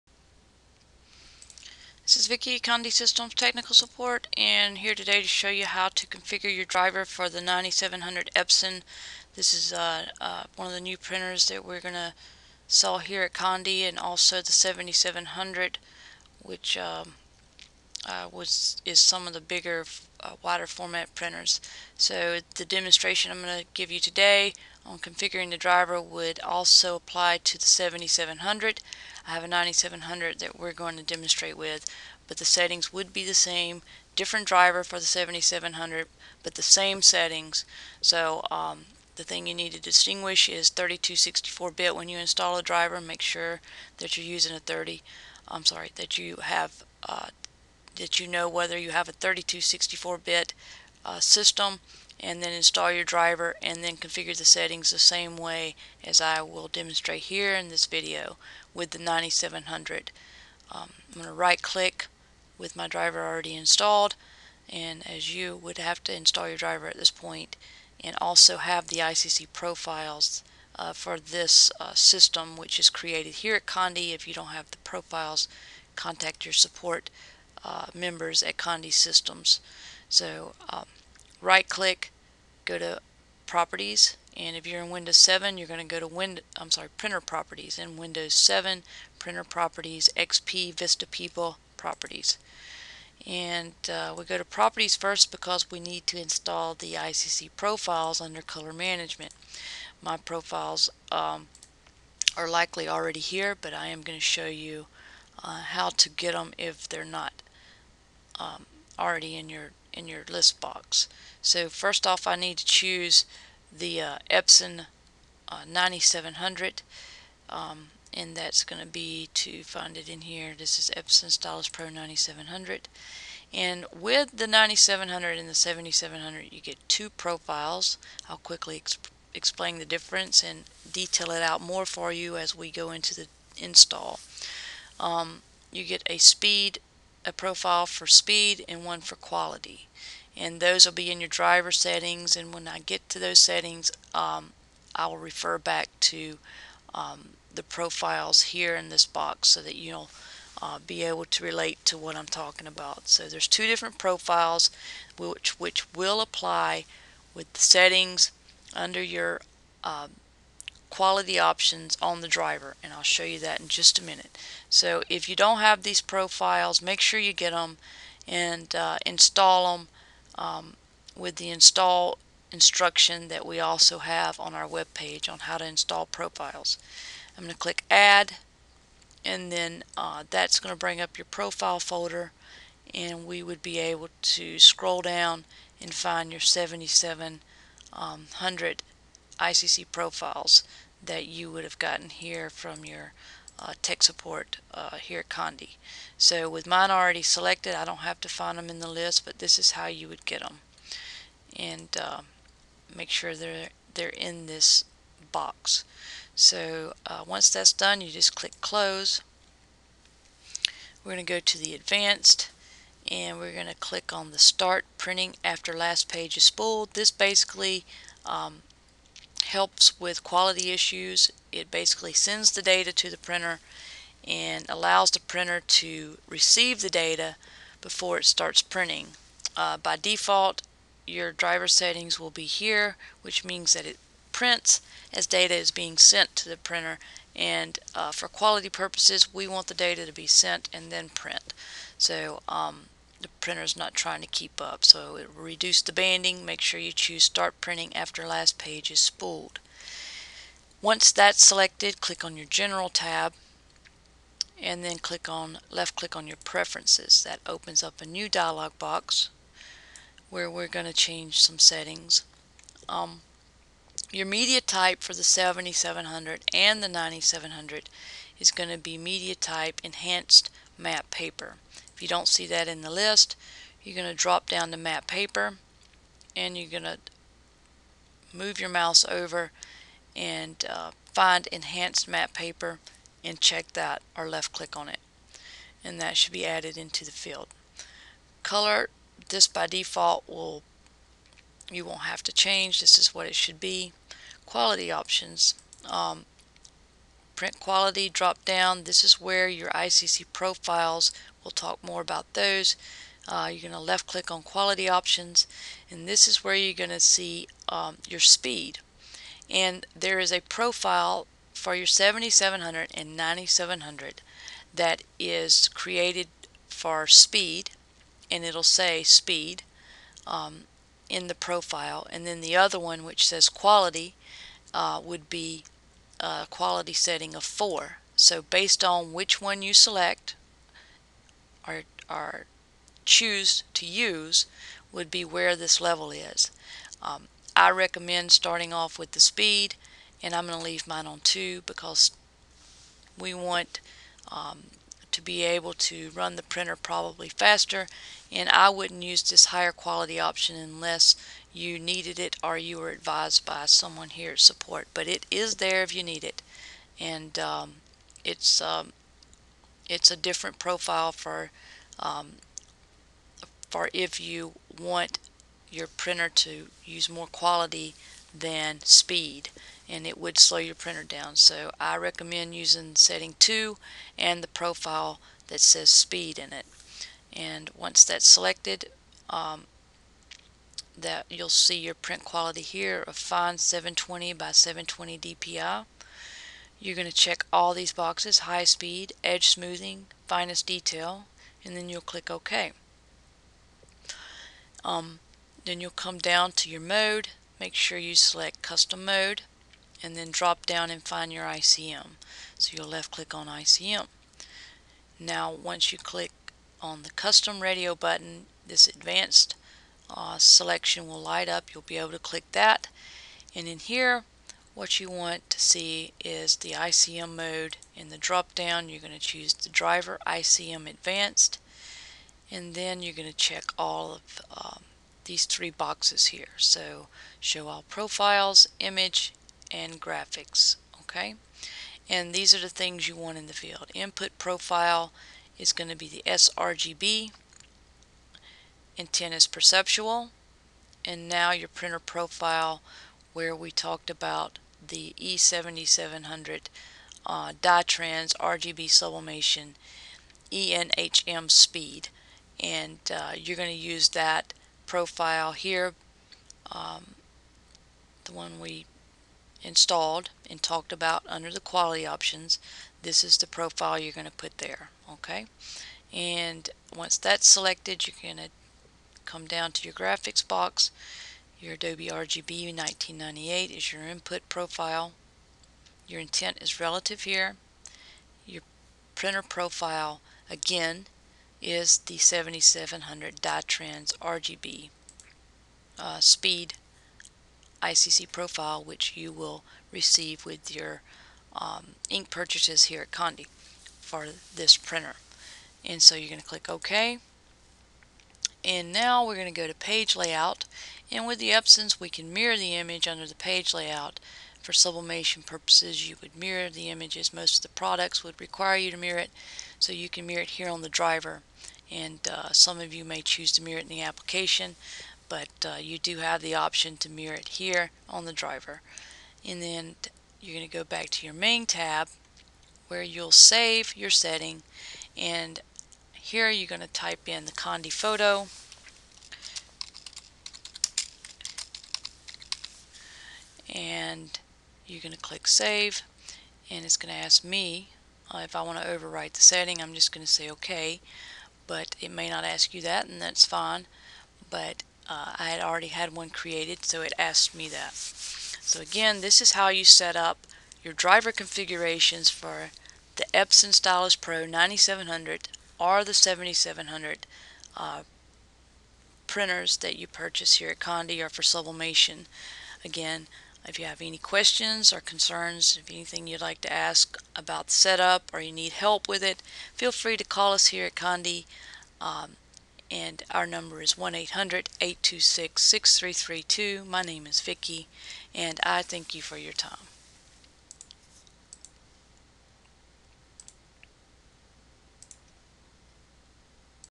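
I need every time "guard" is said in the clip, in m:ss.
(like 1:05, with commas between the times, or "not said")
not said.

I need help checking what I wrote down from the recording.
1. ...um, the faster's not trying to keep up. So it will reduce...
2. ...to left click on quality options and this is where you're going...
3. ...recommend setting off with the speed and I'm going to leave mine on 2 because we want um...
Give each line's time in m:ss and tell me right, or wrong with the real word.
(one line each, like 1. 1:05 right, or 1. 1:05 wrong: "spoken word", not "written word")
1. 4:02 wrong: "printer", not "faster"
2. 5:03 right
3. 5:37 wrong: "starting", not "setting".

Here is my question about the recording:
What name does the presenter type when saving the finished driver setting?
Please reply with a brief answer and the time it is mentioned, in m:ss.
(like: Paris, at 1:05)
Condé photo, at 8:47.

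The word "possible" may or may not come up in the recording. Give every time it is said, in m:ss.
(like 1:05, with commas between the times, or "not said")
not said.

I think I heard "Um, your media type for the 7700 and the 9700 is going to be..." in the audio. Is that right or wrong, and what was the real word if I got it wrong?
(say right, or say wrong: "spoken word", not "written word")
right.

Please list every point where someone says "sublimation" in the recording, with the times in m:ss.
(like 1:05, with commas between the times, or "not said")
7:28, 8:24, 9:21.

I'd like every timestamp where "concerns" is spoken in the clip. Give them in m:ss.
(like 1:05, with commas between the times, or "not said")
9:24.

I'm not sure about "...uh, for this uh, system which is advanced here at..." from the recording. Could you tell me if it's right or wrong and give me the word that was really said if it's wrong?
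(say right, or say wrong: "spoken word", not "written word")
wrong: "created", not "advanced".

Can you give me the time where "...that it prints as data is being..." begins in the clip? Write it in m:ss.
3:53.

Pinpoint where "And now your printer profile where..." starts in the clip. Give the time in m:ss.
7:21.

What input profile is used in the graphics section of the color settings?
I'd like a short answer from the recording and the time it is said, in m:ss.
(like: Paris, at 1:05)
Adobe RGB 1998, at 7:51.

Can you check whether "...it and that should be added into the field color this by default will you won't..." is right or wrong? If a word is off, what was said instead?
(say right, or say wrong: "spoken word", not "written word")
right.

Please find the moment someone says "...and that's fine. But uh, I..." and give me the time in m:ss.
9:03.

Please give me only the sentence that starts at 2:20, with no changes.
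And those will be in your driver settings.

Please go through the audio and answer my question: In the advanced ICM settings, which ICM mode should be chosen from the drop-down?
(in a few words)
Driver ICM advanced.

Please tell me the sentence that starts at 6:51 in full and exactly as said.
You'll be able to click that.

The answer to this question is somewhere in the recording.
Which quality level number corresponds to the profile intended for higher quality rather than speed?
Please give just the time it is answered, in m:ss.
5:27.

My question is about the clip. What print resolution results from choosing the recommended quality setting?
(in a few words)
720 by 720 DPI.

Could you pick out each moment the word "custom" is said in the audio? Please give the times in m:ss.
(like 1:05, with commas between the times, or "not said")
6:38, 6:47.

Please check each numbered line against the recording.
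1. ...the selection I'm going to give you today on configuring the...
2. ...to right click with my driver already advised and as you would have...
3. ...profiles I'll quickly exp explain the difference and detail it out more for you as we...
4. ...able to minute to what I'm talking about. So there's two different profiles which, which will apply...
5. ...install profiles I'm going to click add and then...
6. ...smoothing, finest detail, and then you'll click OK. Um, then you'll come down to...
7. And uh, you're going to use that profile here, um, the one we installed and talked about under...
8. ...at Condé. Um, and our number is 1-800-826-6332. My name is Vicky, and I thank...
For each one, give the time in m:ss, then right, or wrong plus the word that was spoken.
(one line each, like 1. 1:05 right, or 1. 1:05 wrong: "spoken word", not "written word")
1. 0:22 wrong: "demonstration", not "selection"
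2. 1:01 wrong: "installed", not "advised"
3. 2:07 right
4. 2:31 wrong: "relate", not "minute"
5. 2:55 right
6. 6:29 right
7. 7:32 right
8. 9:30 right.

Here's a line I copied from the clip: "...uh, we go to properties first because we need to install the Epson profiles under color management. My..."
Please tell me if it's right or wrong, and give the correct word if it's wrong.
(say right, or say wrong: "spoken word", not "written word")
wrong: "ICC", not "Epson".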